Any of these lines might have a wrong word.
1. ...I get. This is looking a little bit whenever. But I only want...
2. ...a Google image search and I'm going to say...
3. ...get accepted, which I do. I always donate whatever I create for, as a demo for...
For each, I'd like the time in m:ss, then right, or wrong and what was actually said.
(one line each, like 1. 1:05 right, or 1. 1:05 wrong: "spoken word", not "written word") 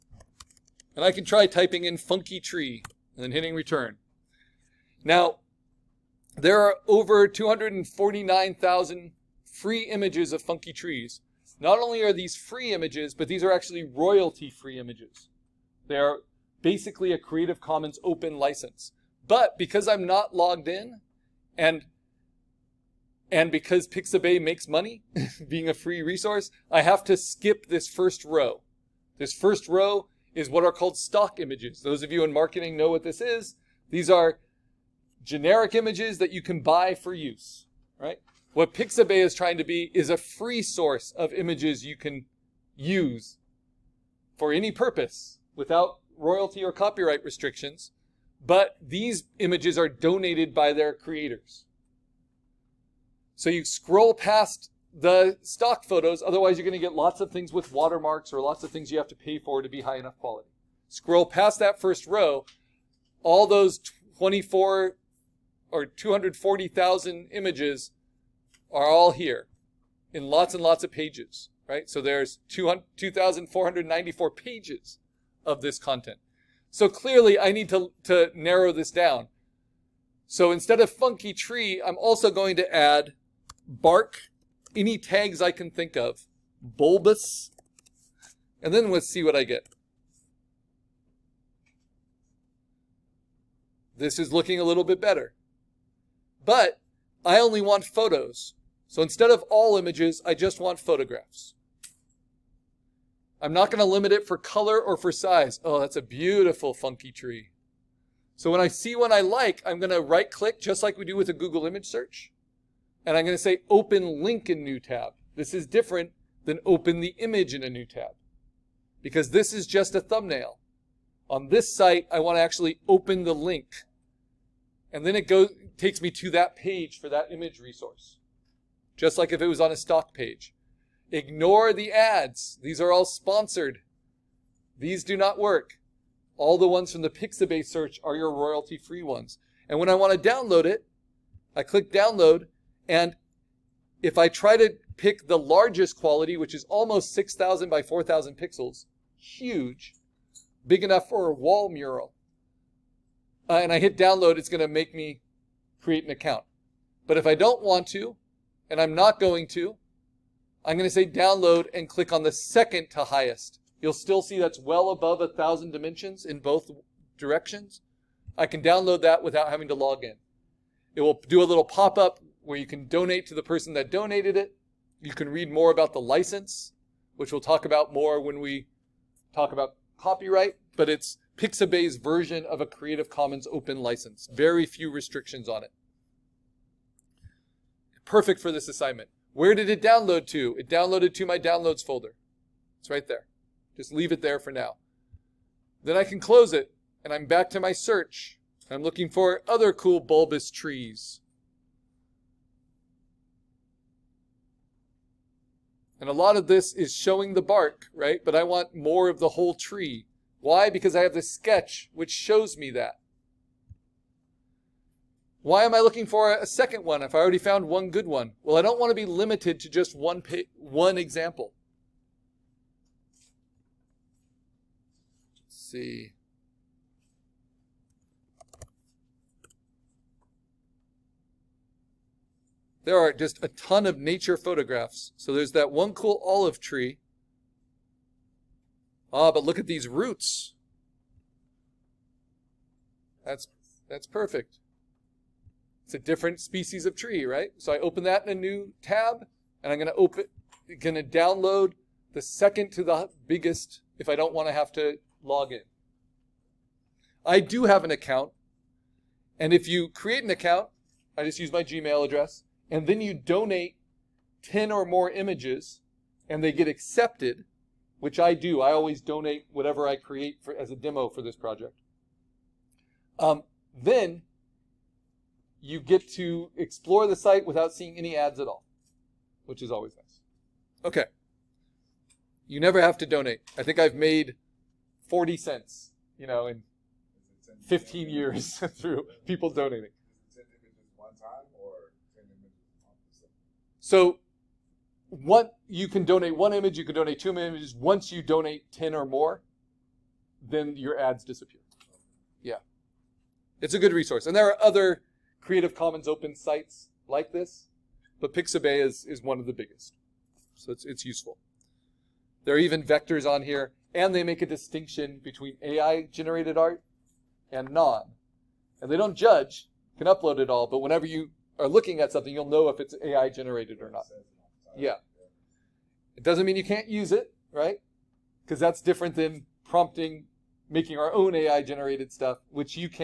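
1. 1:29 wrong: "better", not "whenever"
2. 1:51 right
3. 4:26 right.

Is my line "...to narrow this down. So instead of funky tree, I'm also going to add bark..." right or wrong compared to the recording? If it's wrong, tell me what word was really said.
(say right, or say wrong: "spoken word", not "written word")
right.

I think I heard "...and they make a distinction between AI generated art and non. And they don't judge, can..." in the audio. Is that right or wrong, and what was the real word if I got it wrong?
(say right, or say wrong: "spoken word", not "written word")
right.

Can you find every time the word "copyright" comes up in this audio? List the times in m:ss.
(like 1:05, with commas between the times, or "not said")
0:46, 2:59.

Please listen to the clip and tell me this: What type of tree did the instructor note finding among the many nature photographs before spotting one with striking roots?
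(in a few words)
olive tree.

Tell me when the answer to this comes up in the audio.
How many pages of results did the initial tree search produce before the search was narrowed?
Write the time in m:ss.
1:12.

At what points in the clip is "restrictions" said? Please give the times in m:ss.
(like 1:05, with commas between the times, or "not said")
0:47, 3:04.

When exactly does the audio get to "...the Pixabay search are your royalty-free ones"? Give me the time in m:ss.
2:17.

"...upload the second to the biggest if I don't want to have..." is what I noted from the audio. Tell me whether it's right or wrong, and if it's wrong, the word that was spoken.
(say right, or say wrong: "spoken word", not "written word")
wrong: "download", not "upload".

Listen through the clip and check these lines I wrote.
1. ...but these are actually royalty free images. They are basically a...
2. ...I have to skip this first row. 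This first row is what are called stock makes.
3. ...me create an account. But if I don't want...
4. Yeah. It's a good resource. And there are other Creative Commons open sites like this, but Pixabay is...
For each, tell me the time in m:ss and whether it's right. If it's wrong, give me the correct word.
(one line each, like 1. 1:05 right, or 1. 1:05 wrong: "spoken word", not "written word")
1. 0:13 right
2. 0:26 wrong: "images", not "makes"
3. 2:34 right
4. 5:02 right.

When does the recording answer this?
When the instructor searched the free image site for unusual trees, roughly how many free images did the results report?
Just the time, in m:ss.
0:07.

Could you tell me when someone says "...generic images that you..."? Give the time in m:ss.
0:35.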